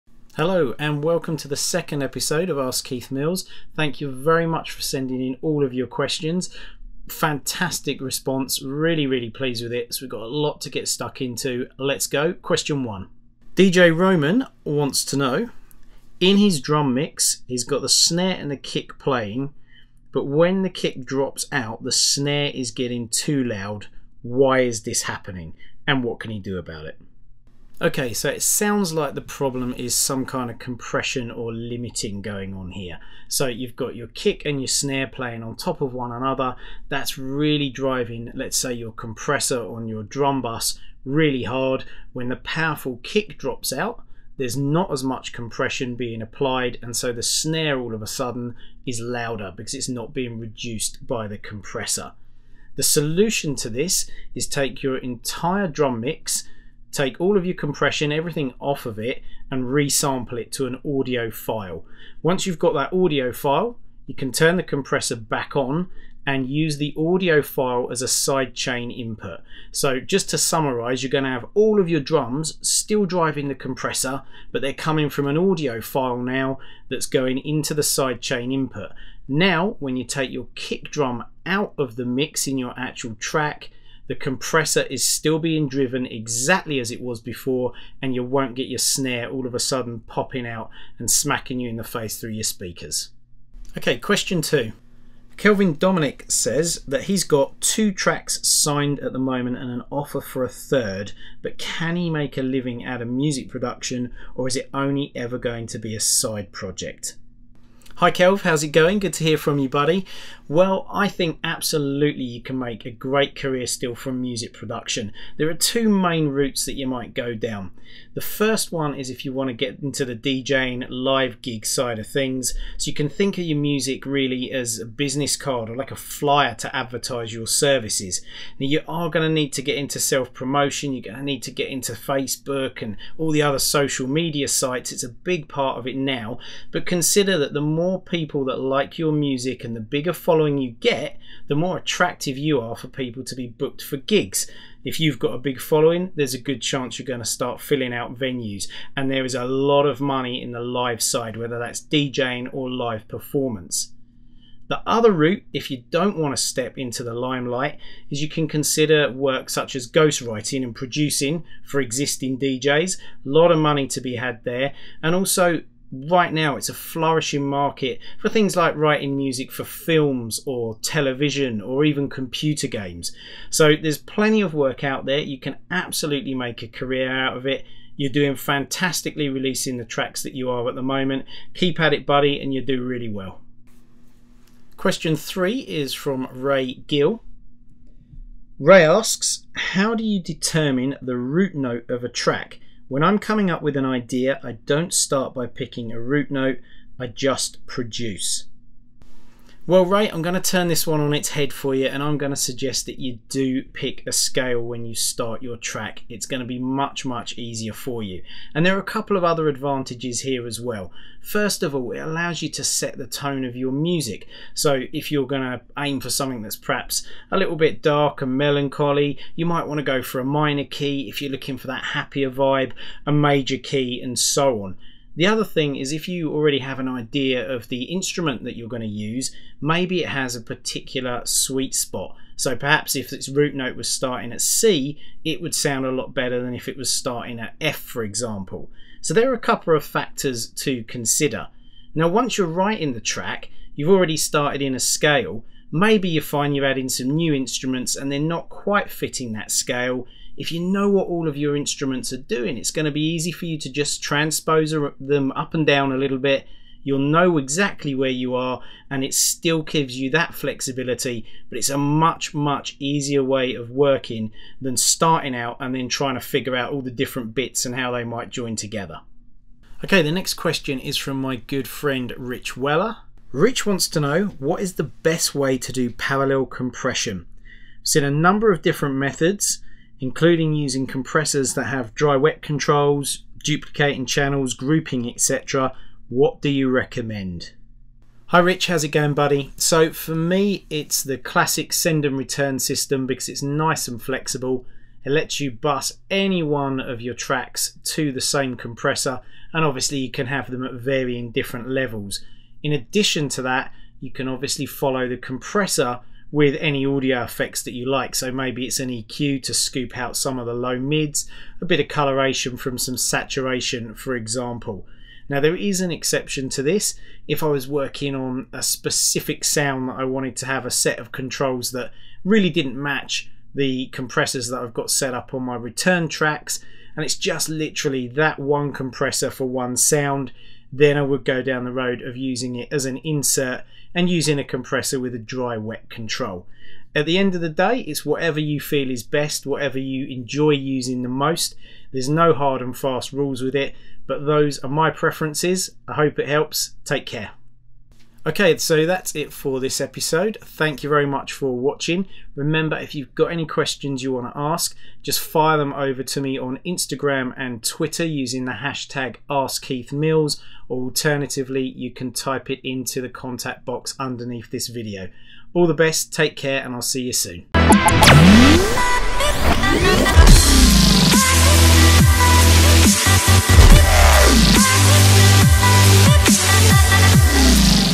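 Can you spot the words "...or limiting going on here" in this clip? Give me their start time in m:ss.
0:31.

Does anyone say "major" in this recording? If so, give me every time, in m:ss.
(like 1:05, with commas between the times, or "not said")
3:43.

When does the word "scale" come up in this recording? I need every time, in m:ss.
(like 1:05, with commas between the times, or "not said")
3:24, 4:04, 4:09.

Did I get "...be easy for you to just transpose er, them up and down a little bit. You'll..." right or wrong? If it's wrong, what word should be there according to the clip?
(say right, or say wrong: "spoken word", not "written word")
right.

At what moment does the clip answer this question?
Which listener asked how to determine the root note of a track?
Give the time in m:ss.
3:06.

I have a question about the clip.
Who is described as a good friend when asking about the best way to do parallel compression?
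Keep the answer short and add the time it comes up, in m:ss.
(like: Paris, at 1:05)
Rich Weller, at 4:32.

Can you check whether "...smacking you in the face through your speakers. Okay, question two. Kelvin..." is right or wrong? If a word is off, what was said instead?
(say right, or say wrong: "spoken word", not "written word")
right.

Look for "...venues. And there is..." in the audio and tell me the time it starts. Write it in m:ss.
2:28.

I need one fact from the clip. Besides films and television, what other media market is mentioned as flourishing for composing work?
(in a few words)
computer games.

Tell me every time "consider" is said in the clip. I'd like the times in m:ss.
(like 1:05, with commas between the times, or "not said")
2:16, 2:38, 4:00.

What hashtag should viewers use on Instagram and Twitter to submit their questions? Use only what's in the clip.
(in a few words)
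AskKeithMills.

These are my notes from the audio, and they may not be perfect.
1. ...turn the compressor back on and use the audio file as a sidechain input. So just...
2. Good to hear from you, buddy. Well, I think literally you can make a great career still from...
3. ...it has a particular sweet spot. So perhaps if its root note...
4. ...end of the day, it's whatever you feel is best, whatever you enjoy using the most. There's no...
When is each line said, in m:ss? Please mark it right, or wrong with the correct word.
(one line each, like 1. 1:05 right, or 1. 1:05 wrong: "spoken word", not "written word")
1. 1:04 right
2. 1:48 wrong: "absolutely", not "literally"
3. 3:50 right
4. 5:37 right.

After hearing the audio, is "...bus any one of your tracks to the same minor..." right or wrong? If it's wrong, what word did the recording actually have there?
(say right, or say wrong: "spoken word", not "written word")
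wrong: "compressor", not "minor".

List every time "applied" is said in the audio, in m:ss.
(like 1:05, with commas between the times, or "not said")
0:46.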